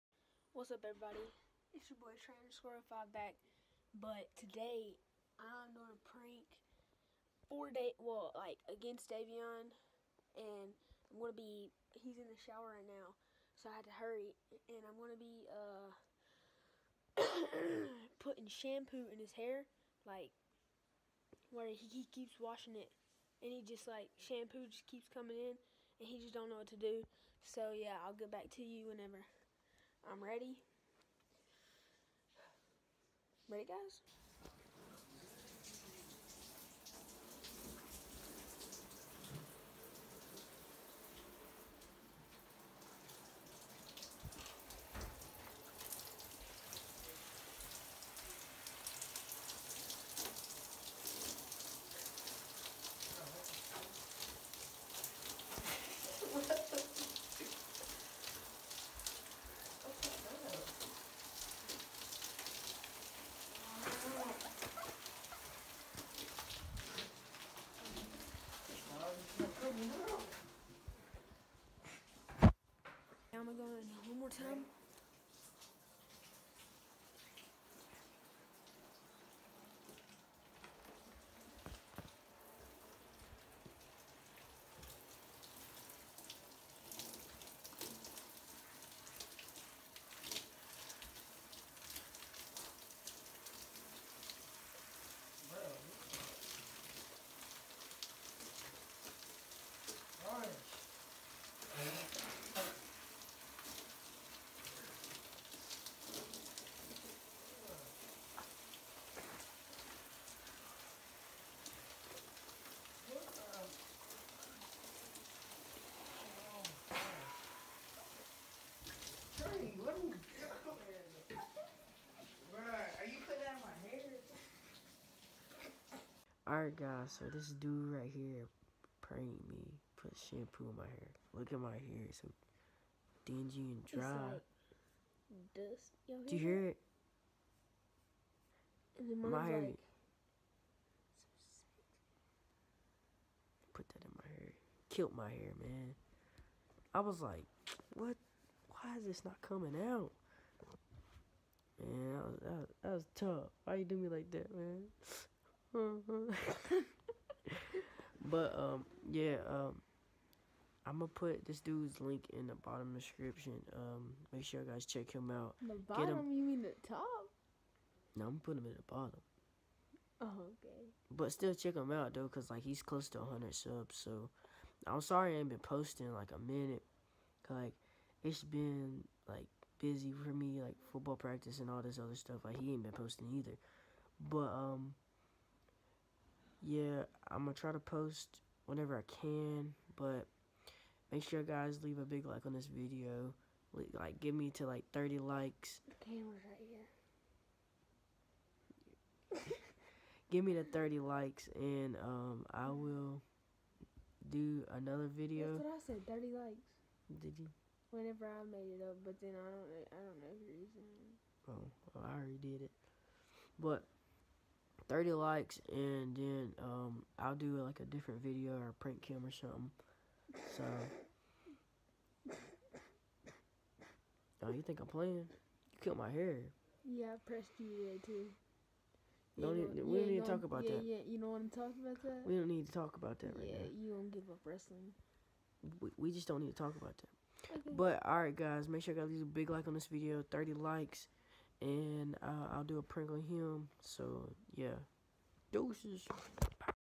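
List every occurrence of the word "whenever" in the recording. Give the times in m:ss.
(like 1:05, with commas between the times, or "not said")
0:28, 3:08, 3:27.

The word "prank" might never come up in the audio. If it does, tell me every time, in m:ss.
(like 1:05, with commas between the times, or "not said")
0:06, 3:38, 4:02.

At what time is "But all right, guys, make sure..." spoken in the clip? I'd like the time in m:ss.
3:57.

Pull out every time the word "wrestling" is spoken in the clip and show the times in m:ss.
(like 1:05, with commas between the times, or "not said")
3:54.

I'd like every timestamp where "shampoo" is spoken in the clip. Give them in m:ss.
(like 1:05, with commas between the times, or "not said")
0:18, 0:24, 2:10.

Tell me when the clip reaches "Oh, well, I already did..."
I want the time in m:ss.
3:31.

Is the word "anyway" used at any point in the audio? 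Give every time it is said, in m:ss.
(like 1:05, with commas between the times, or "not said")
not said.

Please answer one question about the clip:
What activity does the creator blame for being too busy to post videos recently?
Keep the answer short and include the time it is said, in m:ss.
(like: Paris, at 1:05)
football practice, at 3:00.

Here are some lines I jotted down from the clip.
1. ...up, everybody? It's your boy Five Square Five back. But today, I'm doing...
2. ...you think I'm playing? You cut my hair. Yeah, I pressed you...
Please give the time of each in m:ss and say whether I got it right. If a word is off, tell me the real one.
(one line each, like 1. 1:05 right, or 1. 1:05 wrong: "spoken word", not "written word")
1. 0:00 wrong: "Trainer", not "Five"
2. 3:44 right.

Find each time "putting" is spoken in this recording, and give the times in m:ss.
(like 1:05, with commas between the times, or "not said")
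0:18, 2:48.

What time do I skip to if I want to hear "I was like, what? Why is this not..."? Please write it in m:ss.
2:26.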